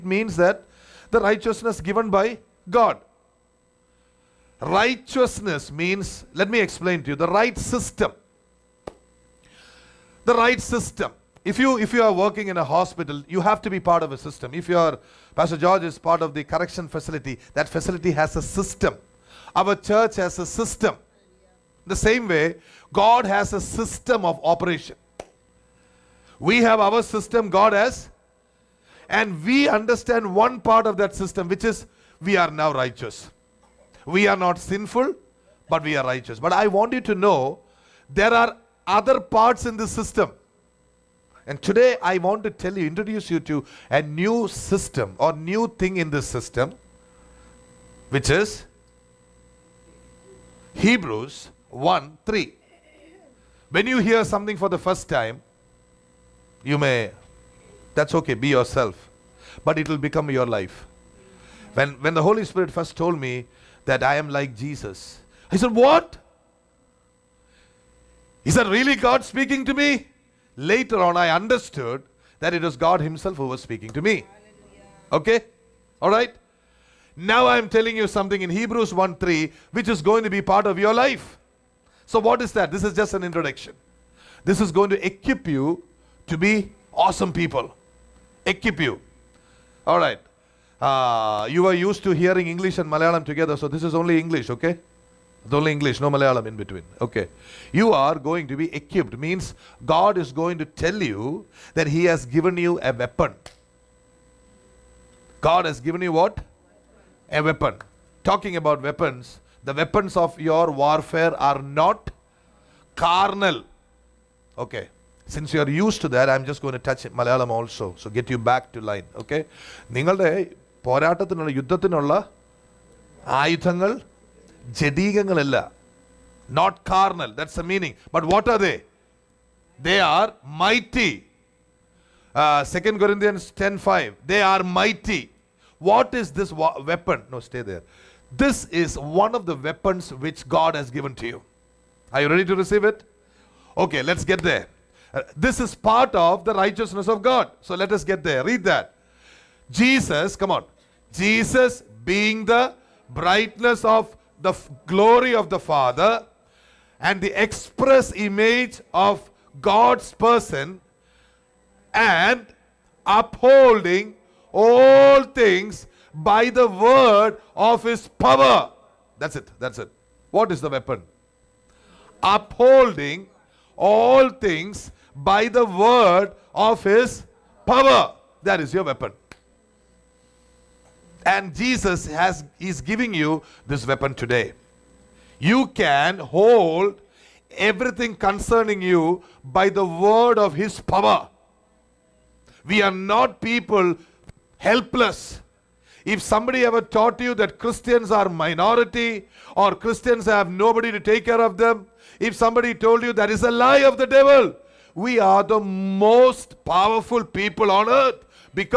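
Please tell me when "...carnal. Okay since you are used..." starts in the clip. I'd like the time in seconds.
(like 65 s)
112 s.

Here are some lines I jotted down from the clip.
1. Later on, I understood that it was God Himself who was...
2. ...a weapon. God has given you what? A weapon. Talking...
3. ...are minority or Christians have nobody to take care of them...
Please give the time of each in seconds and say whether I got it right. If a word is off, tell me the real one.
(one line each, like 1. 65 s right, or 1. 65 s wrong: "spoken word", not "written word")
1. 70 s right
2. 102 s right
3. 198 s right.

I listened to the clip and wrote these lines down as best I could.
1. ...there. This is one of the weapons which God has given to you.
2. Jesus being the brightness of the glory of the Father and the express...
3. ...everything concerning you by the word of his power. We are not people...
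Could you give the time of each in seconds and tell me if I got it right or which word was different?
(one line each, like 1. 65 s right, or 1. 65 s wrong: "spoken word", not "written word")
1. 137 s right
2. 151 s right
3. 187 s right.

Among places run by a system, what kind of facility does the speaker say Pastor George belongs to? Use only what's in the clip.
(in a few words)
correction facility.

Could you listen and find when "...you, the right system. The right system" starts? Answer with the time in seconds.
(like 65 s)
7 s.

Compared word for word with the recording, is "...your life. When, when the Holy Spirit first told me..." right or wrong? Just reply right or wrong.
right.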